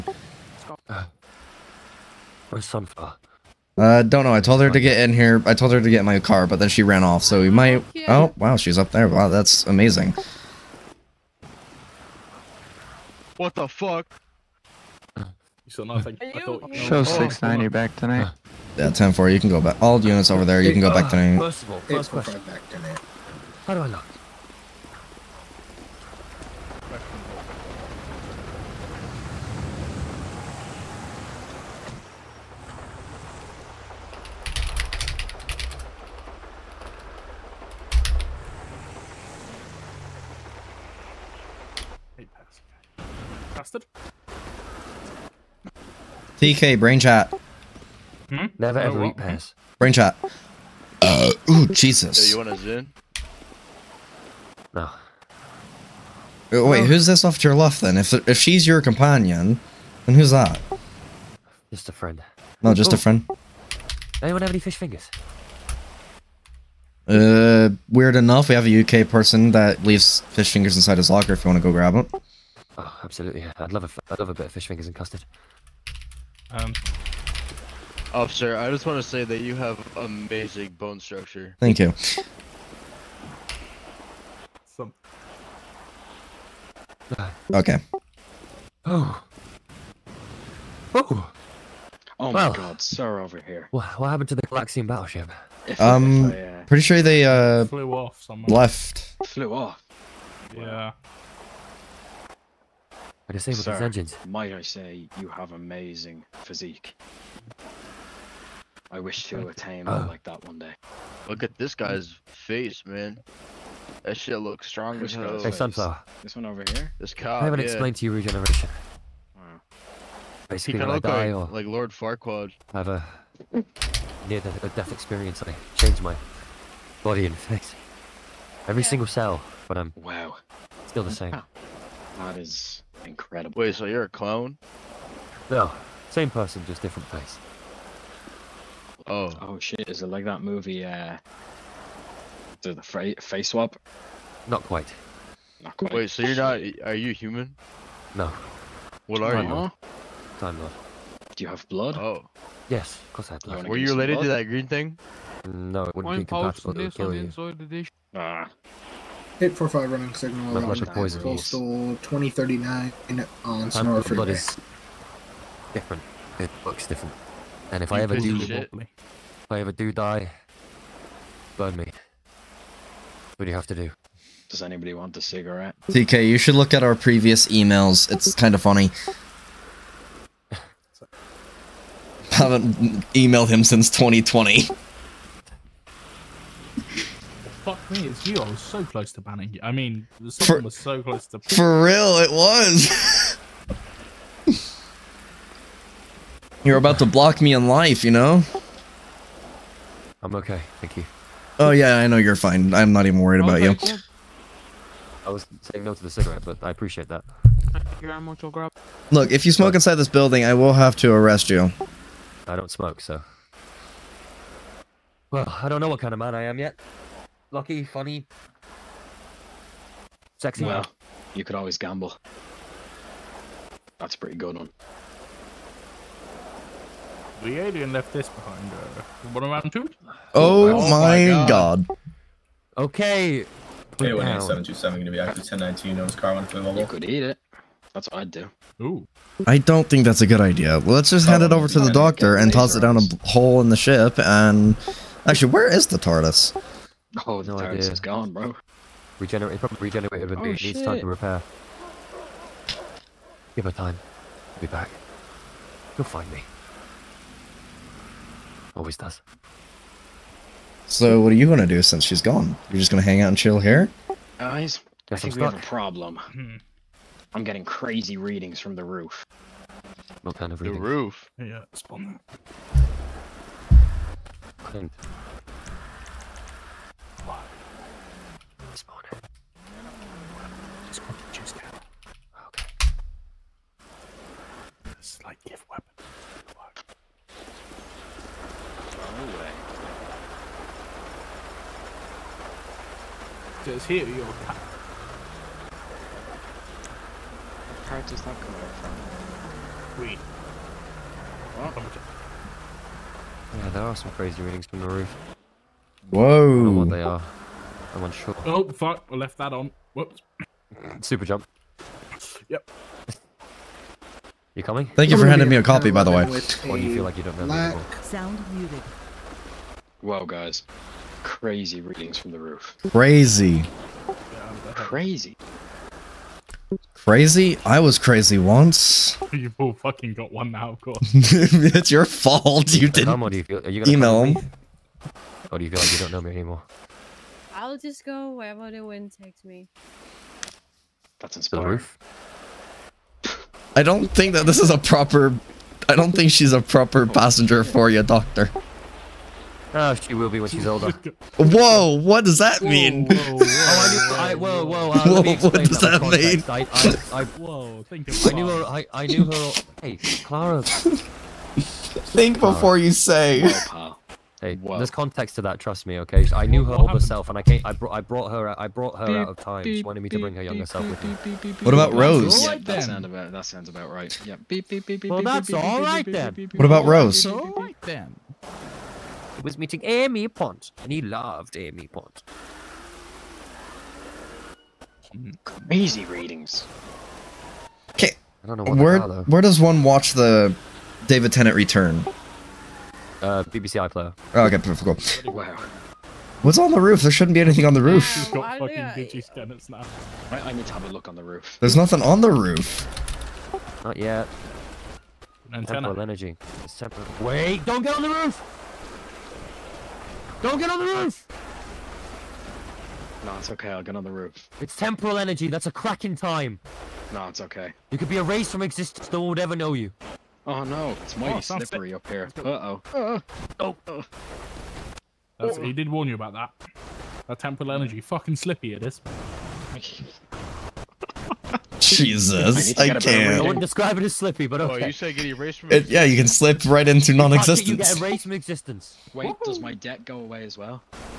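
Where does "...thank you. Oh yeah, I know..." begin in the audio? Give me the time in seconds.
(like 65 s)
200 s.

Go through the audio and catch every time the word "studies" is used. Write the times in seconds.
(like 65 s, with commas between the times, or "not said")
not said.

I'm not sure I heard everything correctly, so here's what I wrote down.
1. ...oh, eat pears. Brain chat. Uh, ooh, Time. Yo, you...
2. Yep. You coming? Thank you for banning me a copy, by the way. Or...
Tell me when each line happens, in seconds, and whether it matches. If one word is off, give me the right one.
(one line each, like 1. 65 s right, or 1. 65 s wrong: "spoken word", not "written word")
1. 49 s wrong: "Jesus", not "Time"
2. 312 s wrong: "handing", not "banning".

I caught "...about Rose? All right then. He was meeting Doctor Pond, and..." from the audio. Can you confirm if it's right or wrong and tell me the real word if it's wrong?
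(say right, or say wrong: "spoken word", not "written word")
wrong: "Amy", not "Doctor".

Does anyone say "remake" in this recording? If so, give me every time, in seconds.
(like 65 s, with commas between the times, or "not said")
not said.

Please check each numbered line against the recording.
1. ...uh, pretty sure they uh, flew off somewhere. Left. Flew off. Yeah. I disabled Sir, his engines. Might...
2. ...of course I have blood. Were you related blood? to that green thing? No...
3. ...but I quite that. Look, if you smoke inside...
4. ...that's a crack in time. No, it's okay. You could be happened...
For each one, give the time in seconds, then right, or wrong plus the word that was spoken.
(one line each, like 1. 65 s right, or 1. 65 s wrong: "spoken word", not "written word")
1. 96 s right
2. 153 s right
3. 206 s wrong: "appreciate", not "quite"
4. 415 s wrong: "erased", not "happened".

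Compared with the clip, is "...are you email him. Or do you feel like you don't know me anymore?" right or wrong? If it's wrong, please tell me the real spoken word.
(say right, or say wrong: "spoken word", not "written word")
right.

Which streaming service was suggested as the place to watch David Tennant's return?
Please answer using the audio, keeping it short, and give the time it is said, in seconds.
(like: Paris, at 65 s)
BBC iPlayer, at 393 s.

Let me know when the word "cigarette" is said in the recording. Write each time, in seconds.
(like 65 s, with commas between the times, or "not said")
175 s, 206 s.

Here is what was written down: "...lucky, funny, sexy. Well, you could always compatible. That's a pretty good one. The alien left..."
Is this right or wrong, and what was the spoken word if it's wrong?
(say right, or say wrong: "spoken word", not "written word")
wrong: "gamble", not "compatible".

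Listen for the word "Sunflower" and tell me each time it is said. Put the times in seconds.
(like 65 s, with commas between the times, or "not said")
2 s, 115 s.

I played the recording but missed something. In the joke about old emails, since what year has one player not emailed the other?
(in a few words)
2020.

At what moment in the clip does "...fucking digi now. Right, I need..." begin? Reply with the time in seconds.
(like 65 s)
398 s.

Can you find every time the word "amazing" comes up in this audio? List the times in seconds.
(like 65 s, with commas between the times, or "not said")
9 s, 79 s, 105 s.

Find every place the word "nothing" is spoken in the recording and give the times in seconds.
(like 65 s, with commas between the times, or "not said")
15 s, 401 s.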